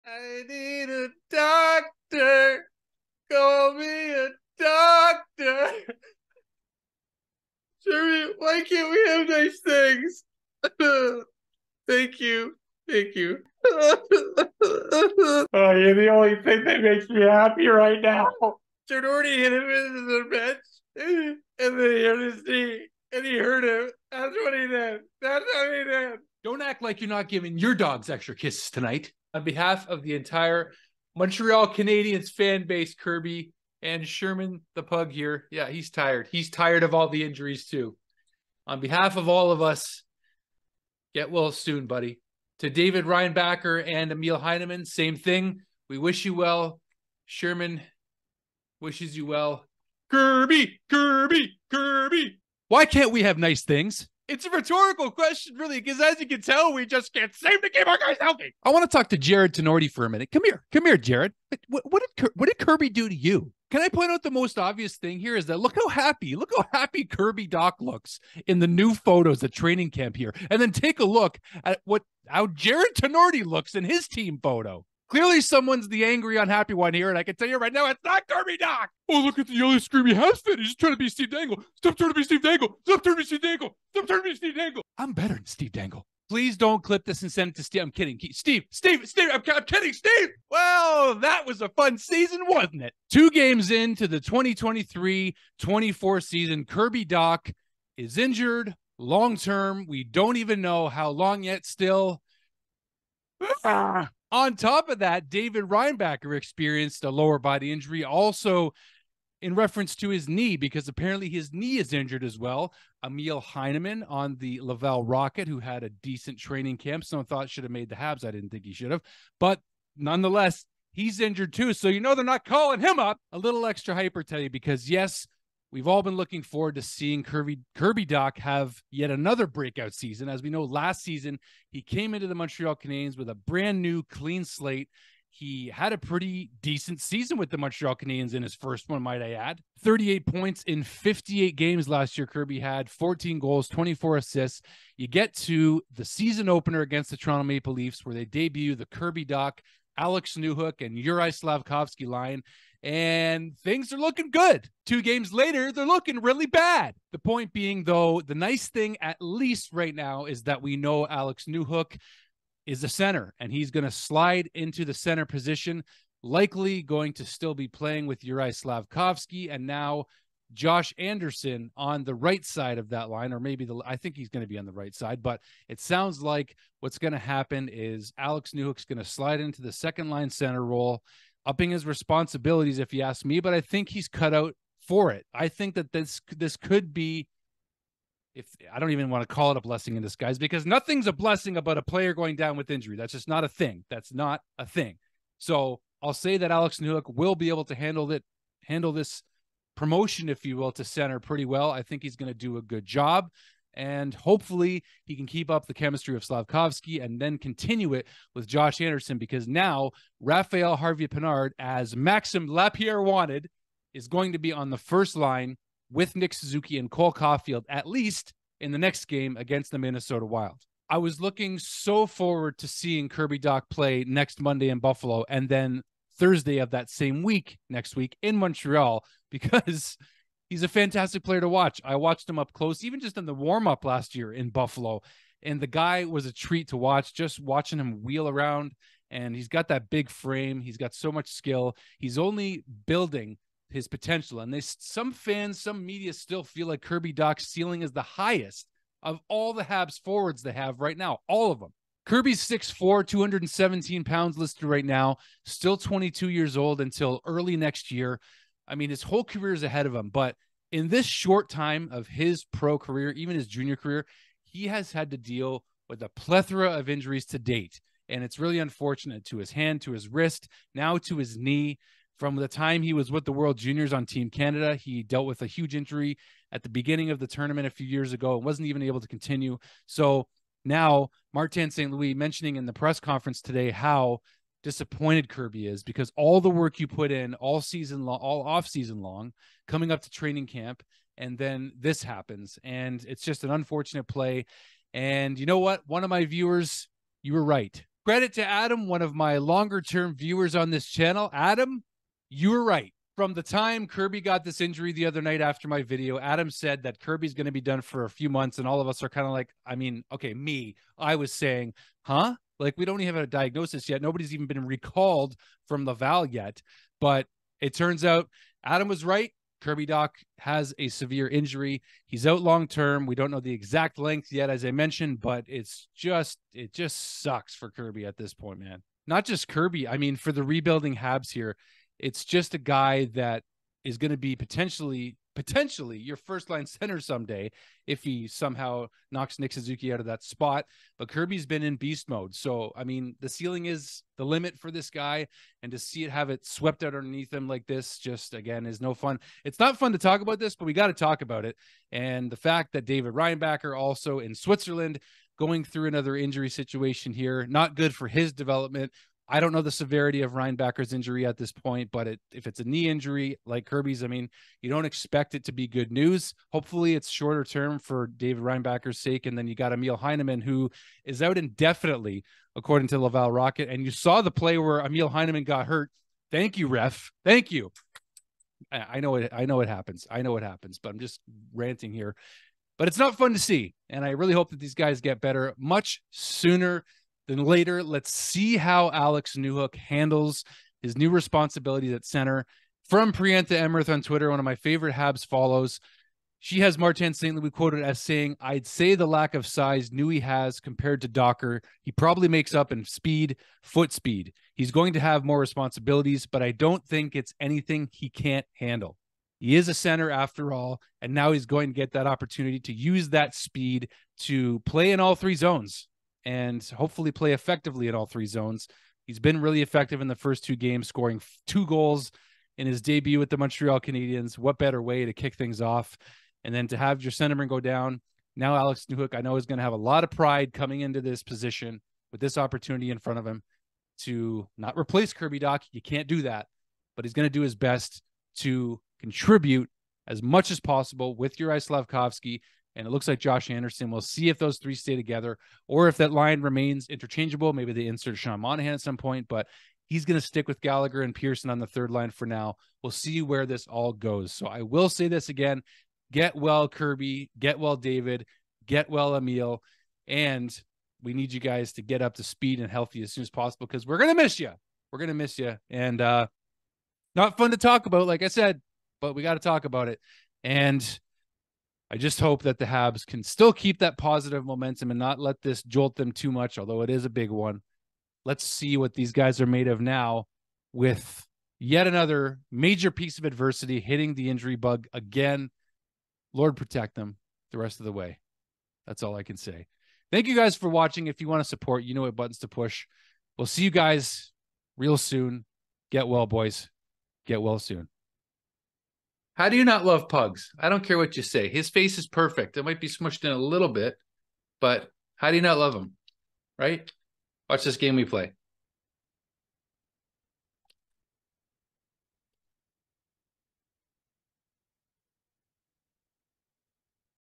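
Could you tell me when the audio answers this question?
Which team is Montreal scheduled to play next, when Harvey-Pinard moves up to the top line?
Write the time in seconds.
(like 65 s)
219 s.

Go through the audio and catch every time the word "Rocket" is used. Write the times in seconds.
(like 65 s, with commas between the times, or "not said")
115 s, 373 s.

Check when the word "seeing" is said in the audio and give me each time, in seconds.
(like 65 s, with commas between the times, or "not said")
126 s, 222 s.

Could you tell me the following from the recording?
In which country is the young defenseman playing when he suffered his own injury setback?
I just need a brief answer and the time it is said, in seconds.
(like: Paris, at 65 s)
Switzerland, at 354 s.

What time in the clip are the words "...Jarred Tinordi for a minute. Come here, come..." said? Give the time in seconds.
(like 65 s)
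59 s.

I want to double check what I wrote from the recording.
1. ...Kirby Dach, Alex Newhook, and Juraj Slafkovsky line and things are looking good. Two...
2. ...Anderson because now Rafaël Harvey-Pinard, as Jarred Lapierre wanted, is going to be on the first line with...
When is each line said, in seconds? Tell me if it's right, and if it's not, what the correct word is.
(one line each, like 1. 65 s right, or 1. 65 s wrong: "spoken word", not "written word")
1. 148 s right
2. 208 s wrong: "Maxim", not "Jarred".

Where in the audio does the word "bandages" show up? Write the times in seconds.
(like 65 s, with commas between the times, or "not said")
not said.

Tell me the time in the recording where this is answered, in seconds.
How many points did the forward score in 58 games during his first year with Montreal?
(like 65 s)
139 s.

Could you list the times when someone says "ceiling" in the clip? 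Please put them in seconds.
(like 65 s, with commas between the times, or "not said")
247 s, 343 s.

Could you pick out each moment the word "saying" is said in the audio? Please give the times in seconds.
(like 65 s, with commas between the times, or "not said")
311 s, 398 s.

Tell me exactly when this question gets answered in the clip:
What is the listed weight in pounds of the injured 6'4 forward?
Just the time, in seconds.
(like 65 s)
253 s.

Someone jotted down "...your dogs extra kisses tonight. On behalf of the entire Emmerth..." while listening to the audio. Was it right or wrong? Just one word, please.
wrong.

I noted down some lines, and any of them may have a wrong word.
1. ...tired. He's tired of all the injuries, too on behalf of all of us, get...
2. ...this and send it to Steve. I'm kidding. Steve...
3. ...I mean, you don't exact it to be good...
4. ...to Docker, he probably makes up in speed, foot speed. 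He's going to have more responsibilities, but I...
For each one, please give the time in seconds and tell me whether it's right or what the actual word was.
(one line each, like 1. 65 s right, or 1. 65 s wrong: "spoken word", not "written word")
1. 35 s right
2. 87 s right
3. 364 s wrong: "expect", not "exact"
4. 401 s right.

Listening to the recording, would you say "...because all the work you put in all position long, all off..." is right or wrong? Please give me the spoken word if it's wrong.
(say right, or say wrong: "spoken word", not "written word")
wrong: "season", not "position".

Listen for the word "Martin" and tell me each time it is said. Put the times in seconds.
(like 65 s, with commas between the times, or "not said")
281 s, 396 s.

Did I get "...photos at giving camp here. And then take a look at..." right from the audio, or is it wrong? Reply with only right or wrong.
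wrong.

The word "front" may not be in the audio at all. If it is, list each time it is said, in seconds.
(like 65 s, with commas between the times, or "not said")
432 s.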